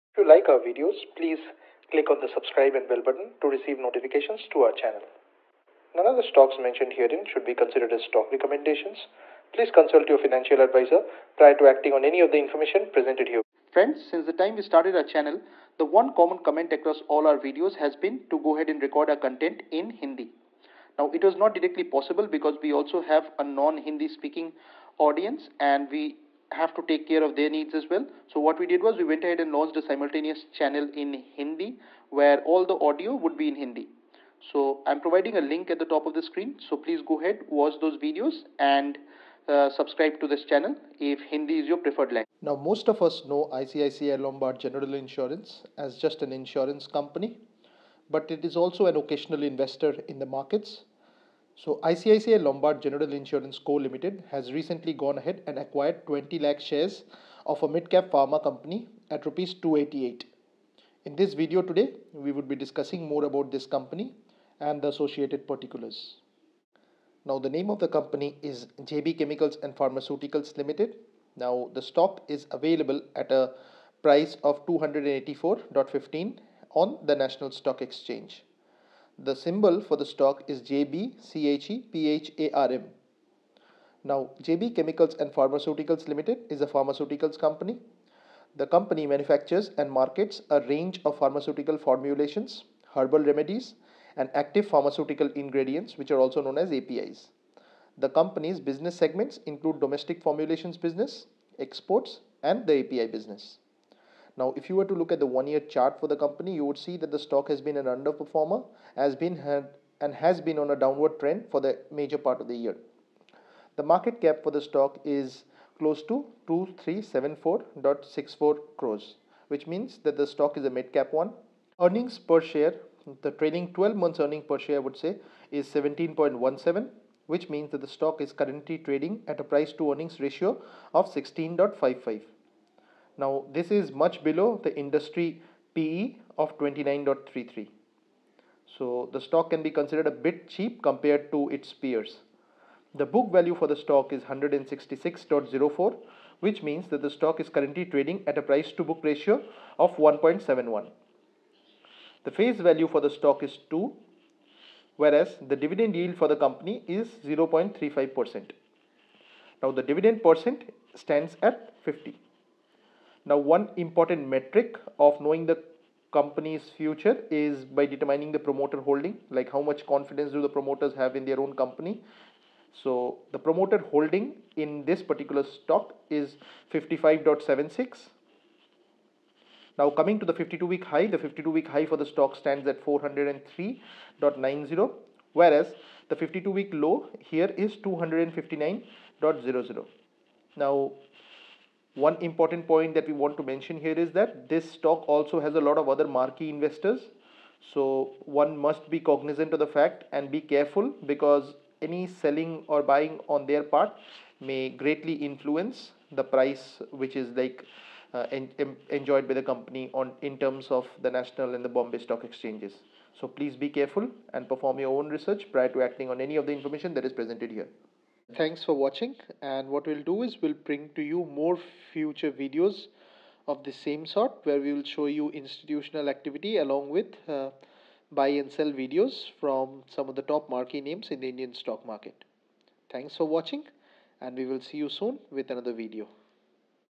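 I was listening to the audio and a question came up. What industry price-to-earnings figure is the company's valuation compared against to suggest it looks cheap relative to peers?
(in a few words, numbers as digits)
29.33.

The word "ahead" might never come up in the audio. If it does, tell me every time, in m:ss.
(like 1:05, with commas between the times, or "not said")
0:18, 0:29, 0:37, 0:55.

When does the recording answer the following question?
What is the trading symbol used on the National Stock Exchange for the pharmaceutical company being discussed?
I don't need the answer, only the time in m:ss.
1:20.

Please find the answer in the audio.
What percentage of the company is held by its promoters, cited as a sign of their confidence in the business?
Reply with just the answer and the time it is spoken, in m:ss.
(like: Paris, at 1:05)
55.76, at 2:56.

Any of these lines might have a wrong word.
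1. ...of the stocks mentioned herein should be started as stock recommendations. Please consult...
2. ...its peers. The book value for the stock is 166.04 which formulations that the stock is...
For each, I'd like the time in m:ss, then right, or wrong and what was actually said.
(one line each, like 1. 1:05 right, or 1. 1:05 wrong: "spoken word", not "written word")
1. 0:06 wrong: "considered", not "started"
2. 2:21 wrong: "means", not "formulations".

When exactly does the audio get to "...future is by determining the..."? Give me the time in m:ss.
2:46.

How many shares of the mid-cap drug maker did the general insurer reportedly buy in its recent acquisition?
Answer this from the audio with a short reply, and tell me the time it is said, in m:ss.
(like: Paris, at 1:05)
20 lakh, at 0:56.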